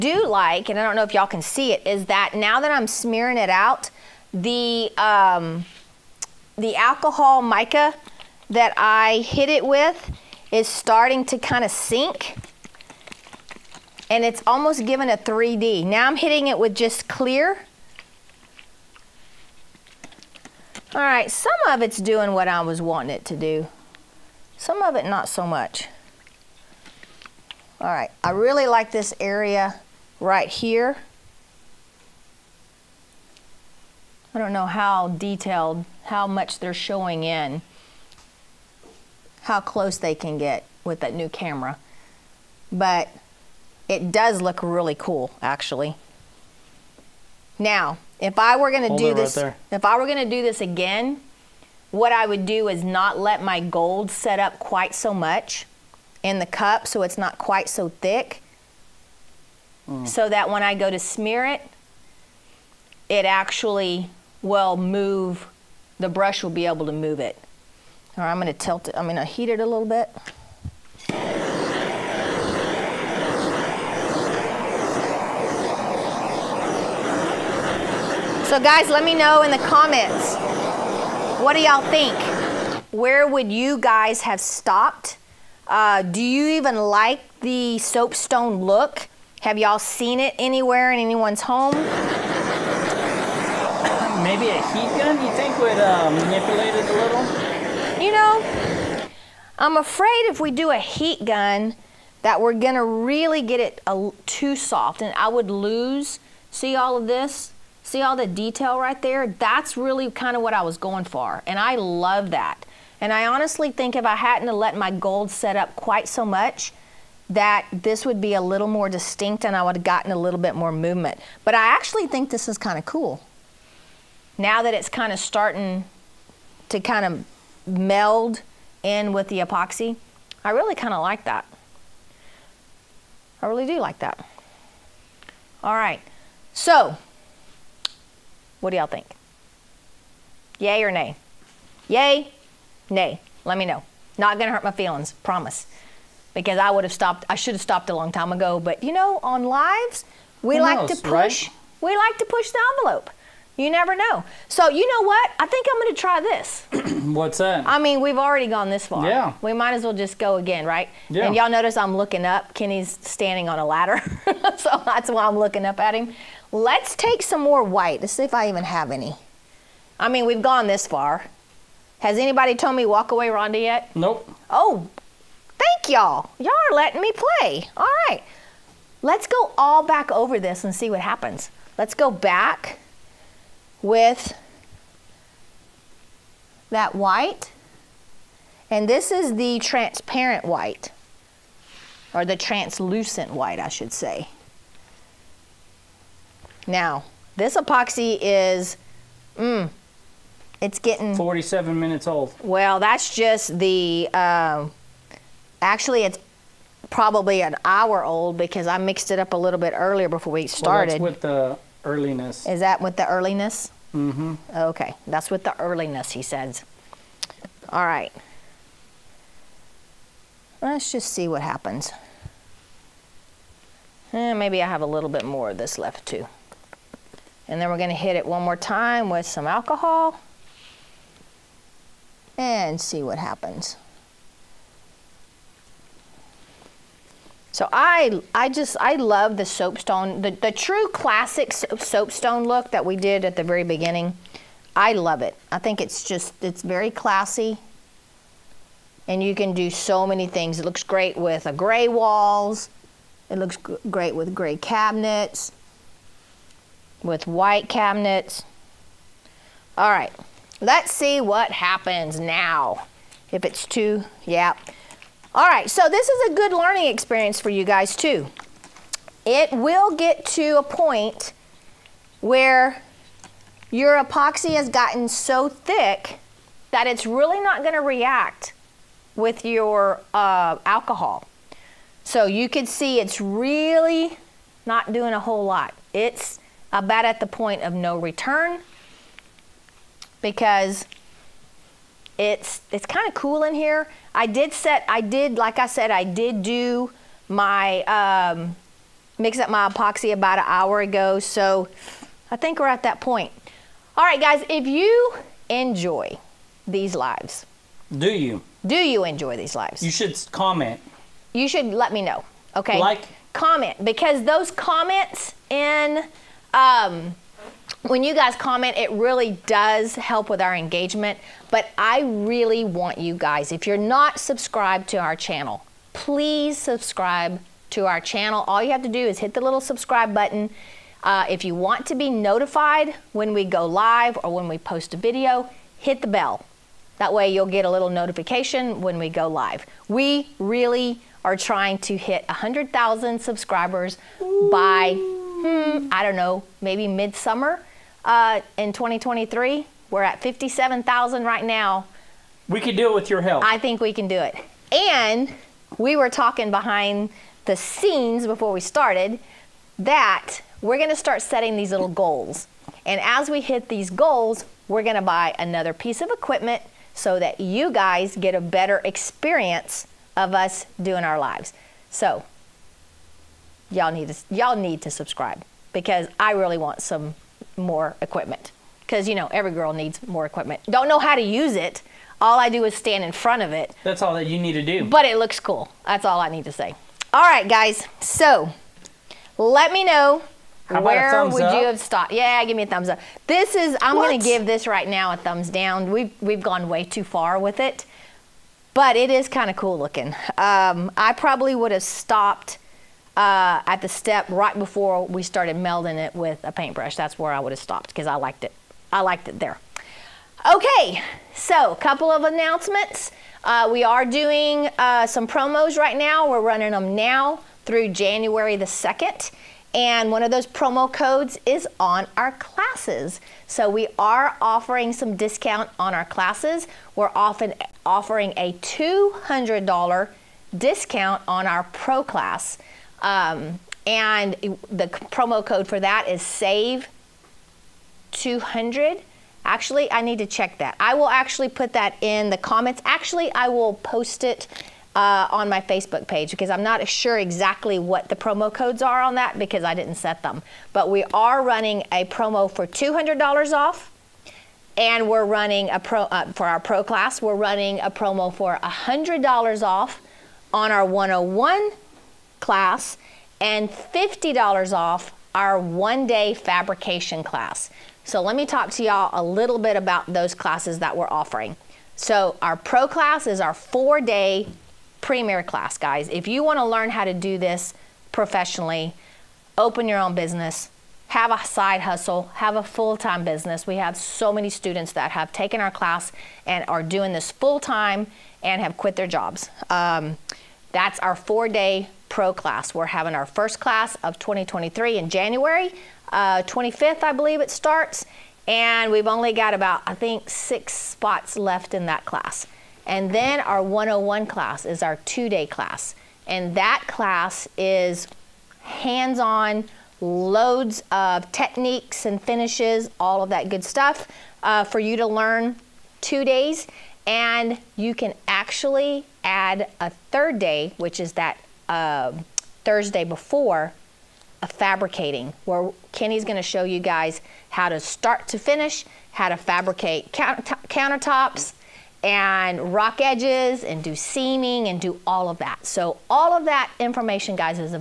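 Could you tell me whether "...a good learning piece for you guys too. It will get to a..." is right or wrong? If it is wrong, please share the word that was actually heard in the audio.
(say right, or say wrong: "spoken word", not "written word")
wrong: "experience", not "piece".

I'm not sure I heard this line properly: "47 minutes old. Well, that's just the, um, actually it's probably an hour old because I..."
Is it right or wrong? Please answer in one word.
right.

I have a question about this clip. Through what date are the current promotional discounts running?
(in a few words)
January 2nd.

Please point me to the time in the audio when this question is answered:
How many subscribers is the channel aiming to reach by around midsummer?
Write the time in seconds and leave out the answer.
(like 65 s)
342 s.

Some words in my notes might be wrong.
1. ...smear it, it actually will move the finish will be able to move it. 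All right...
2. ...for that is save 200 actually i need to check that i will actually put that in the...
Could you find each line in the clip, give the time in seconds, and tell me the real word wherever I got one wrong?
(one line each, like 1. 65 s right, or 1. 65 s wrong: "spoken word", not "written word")
1. 60 s wrong: "brush", not "finish"
2. 435 s right.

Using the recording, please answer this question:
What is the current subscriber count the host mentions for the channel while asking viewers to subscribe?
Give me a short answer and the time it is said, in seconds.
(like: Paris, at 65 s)
57,000, at 350 s.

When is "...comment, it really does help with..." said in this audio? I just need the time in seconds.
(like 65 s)
318 s.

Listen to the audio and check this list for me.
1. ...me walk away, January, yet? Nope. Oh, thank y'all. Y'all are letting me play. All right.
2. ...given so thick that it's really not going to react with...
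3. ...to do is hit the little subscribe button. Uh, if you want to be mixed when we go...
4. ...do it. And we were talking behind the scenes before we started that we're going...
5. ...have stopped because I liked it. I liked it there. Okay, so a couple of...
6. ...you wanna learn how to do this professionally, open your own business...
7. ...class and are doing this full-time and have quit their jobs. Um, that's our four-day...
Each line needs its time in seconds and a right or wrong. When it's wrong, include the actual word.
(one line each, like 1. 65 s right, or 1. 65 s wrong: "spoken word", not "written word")
1. 172 s wrong: "Rhonda", not "January"
2. 274 s wrong: "gotten", not "given"
3. 328 s wrong: "notified", not "mixed"
4. 354 s right
5. 407 s right
6. 476 s right
7. 485 s right.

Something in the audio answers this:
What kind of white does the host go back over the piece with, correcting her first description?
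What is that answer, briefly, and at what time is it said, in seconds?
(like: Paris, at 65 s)
translucent white, at 192 s.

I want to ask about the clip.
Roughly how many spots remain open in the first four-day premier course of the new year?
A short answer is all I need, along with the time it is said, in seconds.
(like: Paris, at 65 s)
6, at 500 s.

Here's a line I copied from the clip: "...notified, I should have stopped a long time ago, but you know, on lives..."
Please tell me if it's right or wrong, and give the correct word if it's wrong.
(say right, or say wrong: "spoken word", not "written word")
wrong: "stopped", not "notified".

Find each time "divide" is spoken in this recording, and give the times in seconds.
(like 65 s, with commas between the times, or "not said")
not said.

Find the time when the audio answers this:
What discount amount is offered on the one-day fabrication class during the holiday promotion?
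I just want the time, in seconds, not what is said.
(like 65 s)
463 s.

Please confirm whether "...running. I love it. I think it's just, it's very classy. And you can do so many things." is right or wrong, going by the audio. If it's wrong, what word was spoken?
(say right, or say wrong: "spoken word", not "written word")
wrong: "beginning", not "running".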